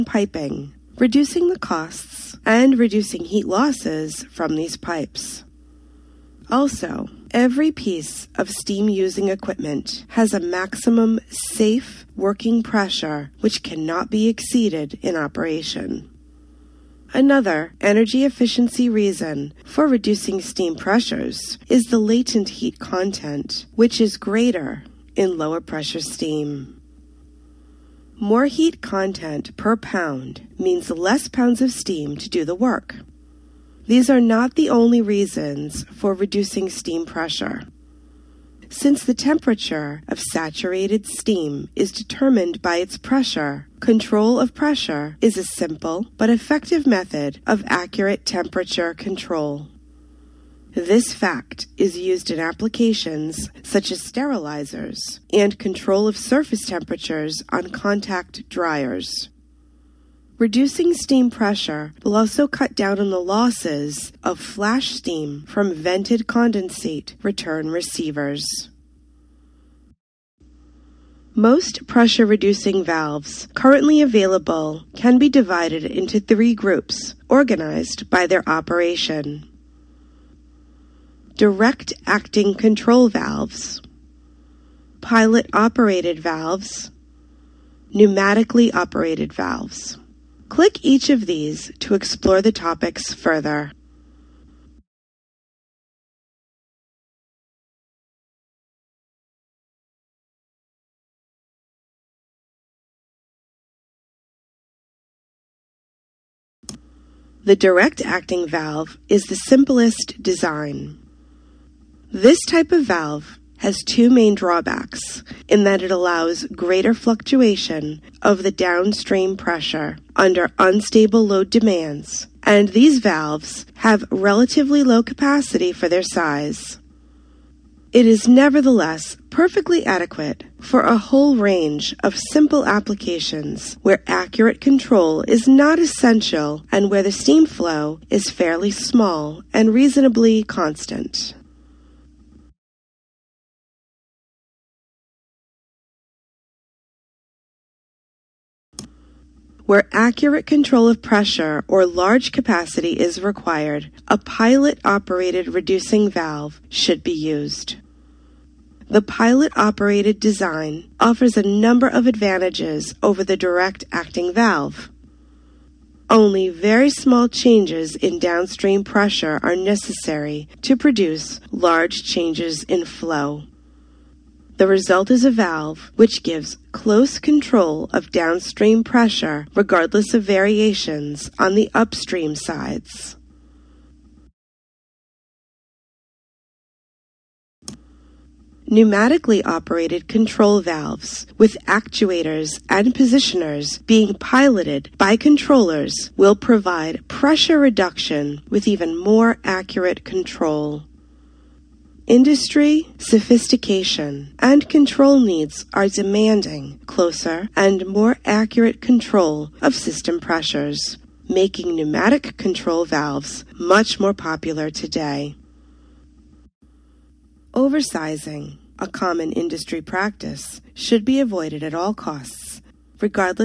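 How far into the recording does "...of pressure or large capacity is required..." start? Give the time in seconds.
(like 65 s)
150 s.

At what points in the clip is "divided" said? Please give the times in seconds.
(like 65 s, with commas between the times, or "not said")
75 s.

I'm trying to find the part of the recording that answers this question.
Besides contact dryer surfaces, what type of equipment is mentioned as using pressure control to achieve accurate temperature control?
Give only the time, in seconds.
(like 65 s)
54 s.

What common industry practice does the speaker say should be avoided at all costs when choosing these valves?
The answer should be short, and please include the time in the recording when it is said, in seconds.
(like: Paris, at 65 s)
Oversizing, at 217 s.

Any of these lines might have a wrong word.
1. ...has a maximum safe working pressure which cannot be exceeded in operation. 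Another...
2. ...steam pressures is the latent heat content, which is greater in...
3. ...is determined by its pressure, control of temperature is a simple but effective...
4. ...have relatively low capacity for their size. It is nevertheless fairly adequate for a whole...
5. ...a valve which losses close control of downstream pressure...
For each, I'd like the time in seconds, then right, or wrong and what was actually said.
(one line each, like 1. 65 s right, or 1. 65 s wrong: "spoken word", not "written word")
1. 10 s right
2. 20 s right
3. 41 s wrong: "pressure", not "temperature"
4. 123 s wrong: "perfectly", not "fairly"
5. 175 s wrong: "gives", not "losses".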